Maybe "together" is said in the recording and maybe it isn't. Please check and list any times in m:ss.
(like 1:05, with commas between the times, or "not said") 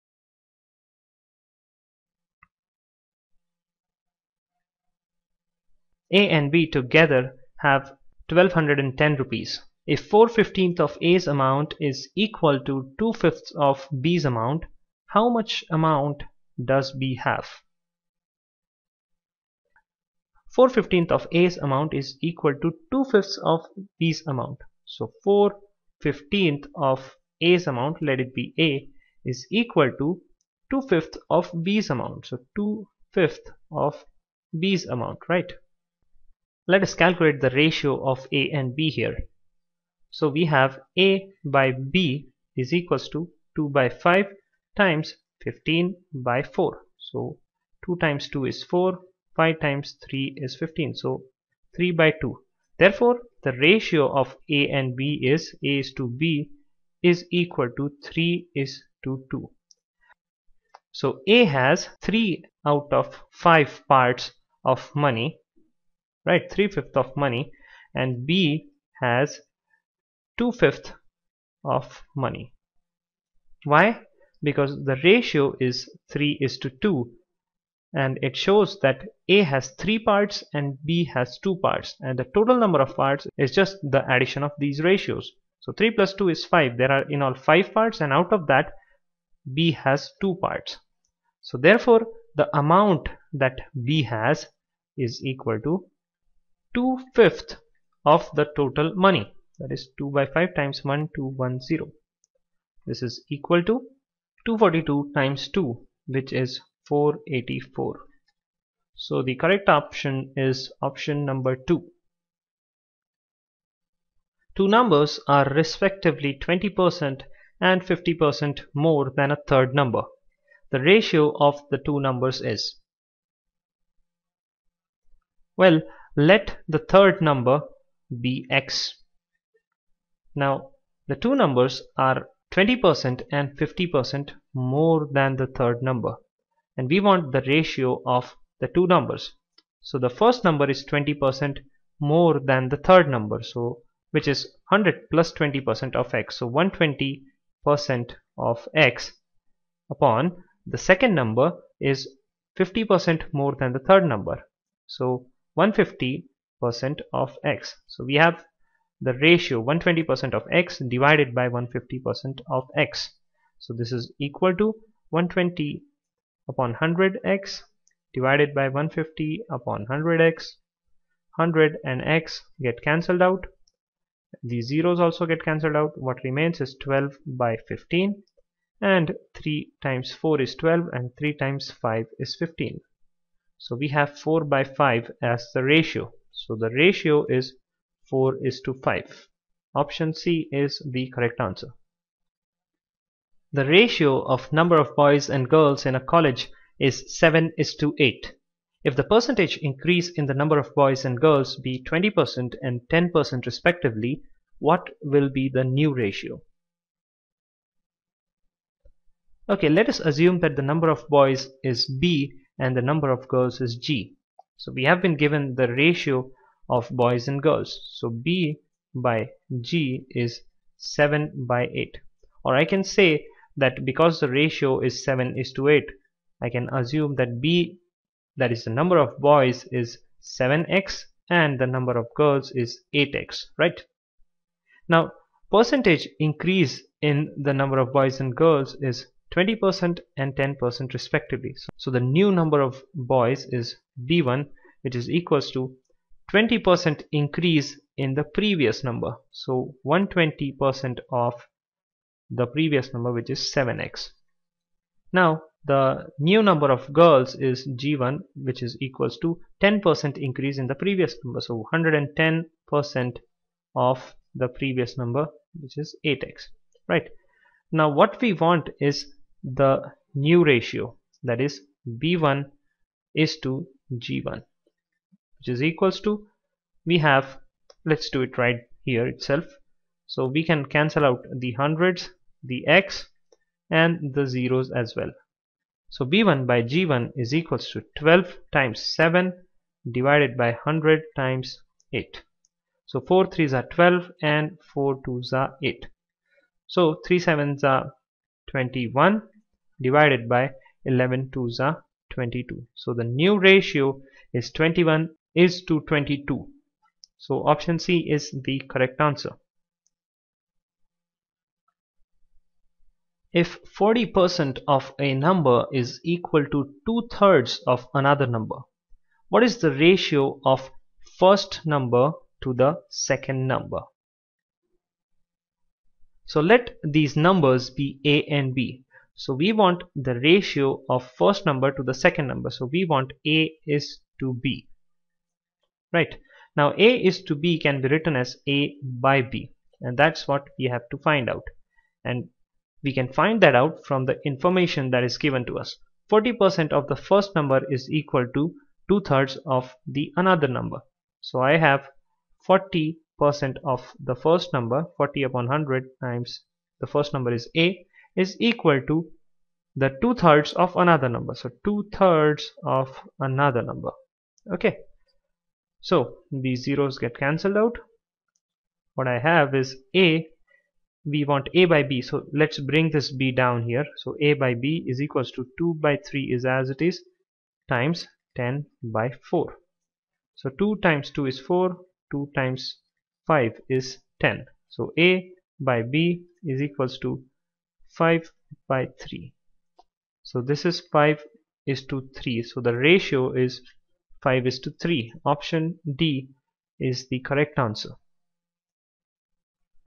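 0:06.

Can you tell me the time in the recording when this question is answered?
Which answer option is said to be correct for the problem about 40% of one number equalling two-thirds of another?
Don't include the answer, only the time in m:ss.
6:35.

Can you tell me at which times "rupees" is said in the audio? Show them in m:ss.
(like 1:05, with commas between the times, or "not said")
0:09.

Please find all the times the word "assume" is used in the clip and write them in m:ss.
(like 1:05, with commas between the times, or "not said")
3:29, 3:46.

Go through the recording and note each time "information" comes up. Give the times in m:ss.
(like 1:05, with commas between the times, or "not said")
5:44.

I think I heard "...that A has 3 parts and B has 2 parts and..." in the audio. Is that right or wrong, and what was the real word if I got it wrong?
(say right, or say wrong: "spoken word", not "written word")
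right.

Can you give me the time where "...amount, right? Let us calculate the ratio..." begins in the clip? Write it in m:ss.
0:34.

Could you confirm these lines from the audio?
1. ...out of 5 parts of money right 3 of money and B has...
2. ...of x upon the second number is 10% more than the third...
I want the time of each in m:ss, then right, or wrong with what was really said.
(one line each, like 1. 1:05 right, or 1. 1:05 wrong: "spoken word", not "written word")
1. 1:02 right
2. 2:28 wrong: "50", not "10".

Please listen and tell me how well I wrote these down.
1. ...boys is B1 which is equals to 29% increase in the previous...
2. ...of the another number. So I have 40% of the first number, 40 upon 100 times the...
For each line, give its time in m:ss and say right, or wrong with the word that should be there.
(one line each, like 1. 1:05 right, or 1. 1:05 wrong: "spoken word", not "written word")
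1. 4:02 wrong: "20", not "29"
2. 5:49 right.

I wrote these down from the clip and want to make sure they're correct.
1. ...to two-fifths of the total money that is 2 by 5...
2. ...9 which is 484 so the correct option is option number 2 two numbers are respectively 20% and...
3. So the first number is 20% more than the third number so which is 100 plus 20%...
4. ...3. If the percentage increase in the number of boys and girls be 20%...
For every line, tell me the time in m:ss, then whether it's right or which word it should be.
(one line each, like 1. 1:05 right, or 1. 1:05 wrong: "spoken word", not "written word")
1. 1:35 right
2. 1:45 wrong: "2", not "9"
3. 2:19 right
4. 3:17 wrong: "8", not "3".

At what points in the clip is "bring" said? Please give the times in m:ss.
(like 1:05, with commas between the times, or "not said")
6:12.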